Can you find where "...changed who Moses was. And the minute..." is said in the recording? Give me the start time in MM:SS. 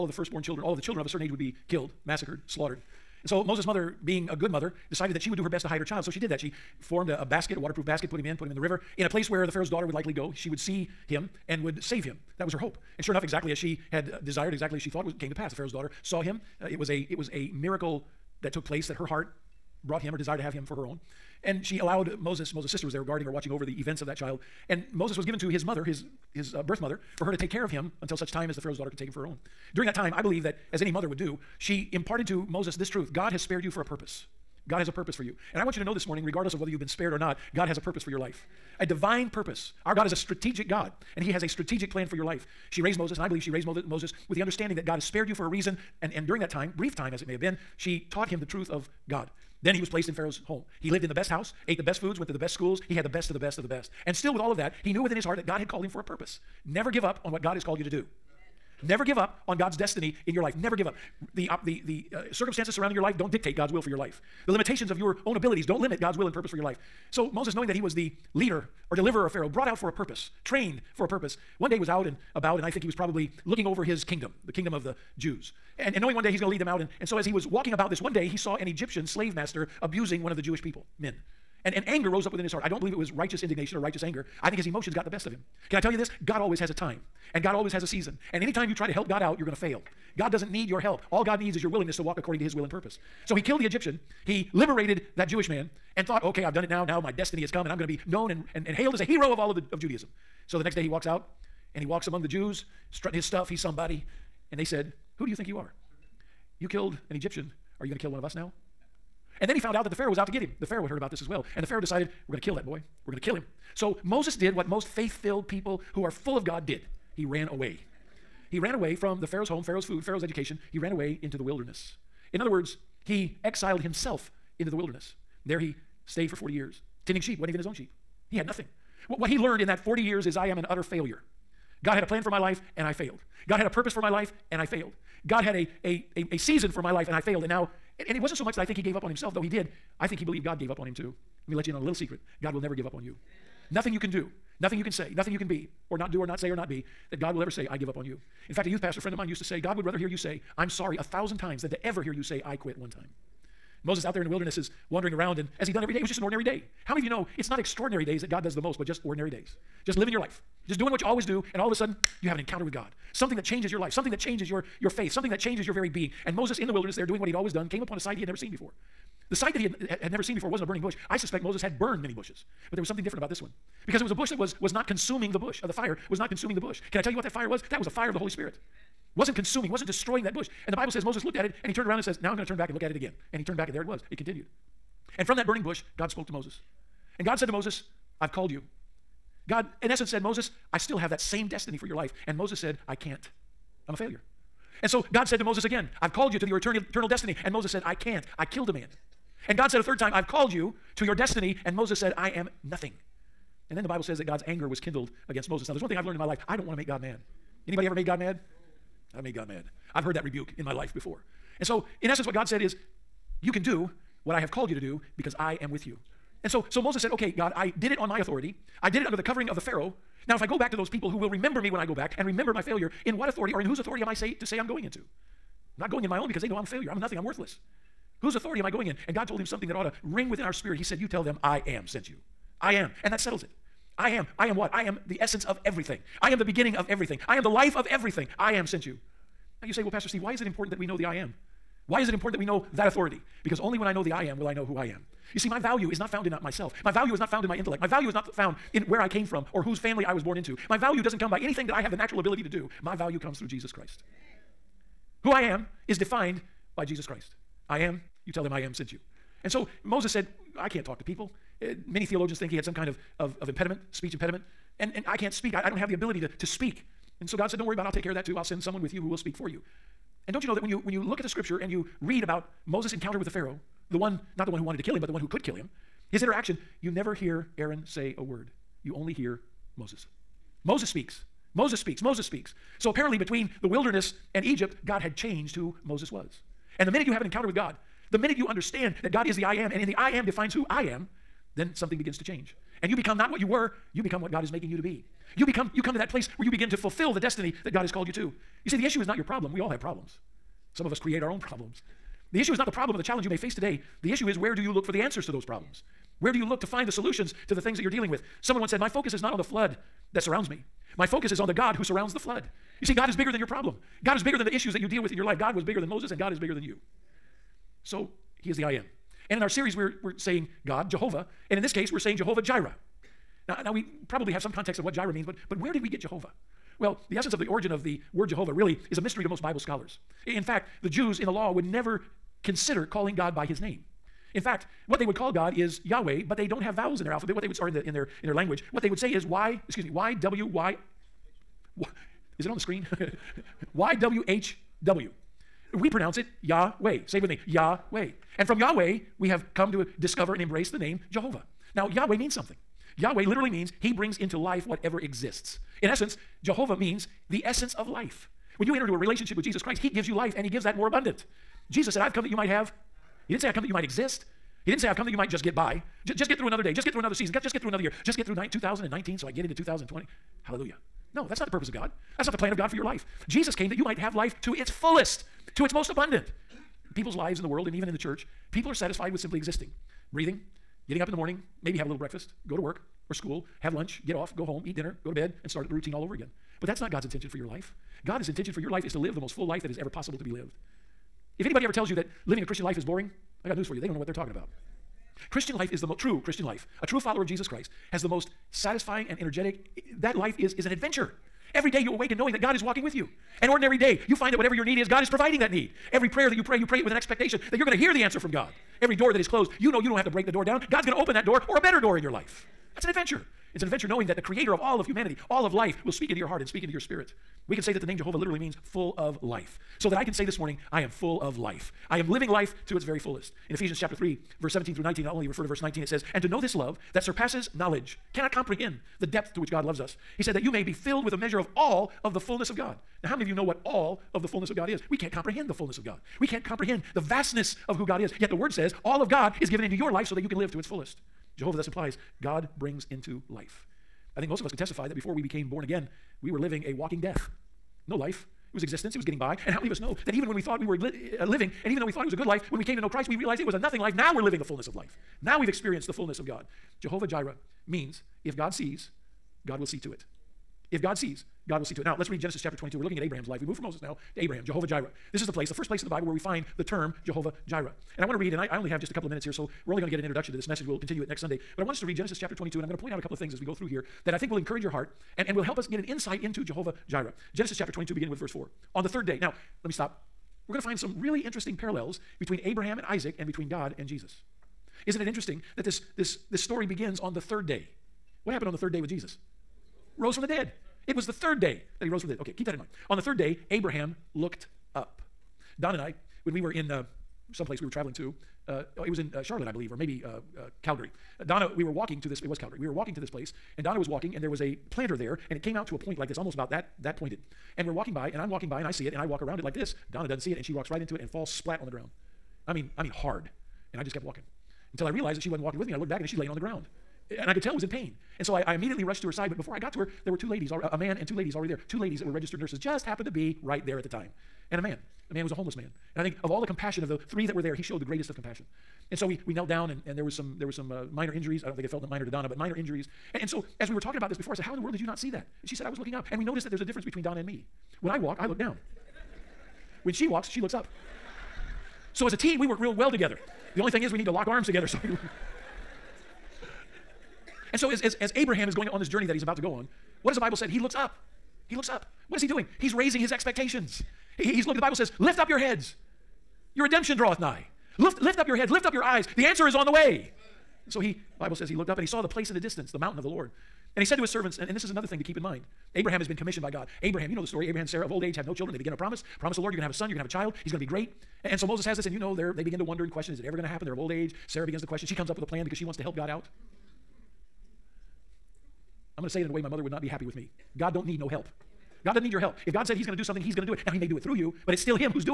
04:45.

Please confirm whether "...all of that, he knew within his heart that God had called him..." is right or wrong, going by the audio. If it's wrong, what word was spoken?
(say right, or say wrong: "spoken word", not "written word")
right.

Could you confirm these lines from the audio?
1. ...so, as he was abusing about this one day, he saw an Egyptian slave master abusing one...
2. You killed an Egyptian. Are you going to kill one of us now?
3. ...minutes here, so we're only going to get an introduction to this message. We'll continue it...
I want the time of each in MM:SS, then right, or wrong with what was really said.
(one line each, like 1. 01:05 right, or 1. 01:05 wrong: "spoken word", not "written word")
1. 01:17 wrong: "walking", not "abusing"
2. 01:46 right
3. 07:49 right.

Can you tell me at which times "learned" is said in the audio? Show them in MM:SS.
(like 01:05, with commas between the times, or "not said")
02:09, 03:26.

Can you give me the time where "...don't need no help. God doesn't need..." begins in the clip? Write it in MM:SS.
09:40.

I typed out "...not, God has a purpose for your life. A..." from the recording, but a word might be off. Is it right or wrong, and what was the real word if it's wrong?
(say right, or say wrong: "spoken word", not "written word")
right.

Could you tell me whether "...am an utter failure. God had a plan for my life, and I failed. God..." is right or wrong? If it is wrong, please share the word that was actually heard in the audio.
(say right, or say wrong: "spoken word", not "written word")
right.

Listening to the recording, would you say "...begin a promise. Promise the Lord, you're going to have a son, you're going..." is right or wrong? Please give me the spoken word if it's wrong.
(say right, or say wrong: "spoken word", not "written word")
right.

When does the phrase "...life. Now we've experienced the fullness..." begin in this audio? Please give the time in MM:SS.
07:34.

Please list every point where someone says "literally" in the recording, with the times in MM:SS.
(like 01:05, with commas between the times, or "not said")
05:53, 06:58.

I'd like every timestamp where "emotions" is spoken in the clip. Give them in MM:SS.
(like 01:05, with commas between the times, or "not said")
01:24.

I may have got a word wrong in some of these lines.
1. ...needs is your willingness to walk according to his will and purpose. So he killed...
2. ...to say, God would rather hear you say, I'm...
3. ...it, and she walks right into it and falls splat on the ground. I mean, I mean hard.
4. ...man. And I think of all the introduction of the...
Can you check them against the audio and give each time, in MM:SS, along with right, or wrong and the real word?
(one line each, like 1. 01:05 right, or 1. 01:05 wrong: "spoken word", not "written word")
1. 01:31 right
2. 02:29 right
3. 08:30 right
4. 08:45 wrong: "compassion", not "introduction".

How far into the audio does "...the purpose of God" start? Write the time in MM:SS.
06:11.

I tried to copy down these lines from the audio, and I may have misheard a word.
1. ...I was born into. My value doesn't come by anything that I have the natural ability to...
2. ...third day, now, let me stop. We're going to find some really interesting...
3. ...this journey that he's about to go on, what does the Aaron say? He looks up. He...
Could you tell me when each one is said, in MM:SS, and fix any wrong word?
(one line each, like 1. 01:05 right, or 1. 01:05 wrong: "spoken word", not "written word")
1. 04:10 right
2. 07:58 right
3. 09:08 wrong: "Bible", not "Aaron".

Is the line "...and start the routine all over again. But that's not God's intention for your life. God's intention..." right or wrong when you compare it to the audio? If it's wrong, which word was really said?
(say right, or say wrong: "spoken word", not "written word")
right.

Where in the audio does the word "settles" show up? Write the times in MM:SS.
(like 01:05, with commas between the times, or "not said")
03:53.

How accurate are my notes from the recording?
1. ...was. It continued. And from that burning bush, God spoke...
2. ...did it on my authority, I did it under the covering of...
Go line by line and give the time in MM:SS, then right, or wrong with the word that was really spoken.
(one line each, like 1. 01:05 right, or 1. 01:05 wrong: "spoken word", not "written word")
1. 03:03 right
2. 03:37 right.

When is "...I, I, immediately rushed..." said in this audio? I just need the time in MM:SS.
08:38.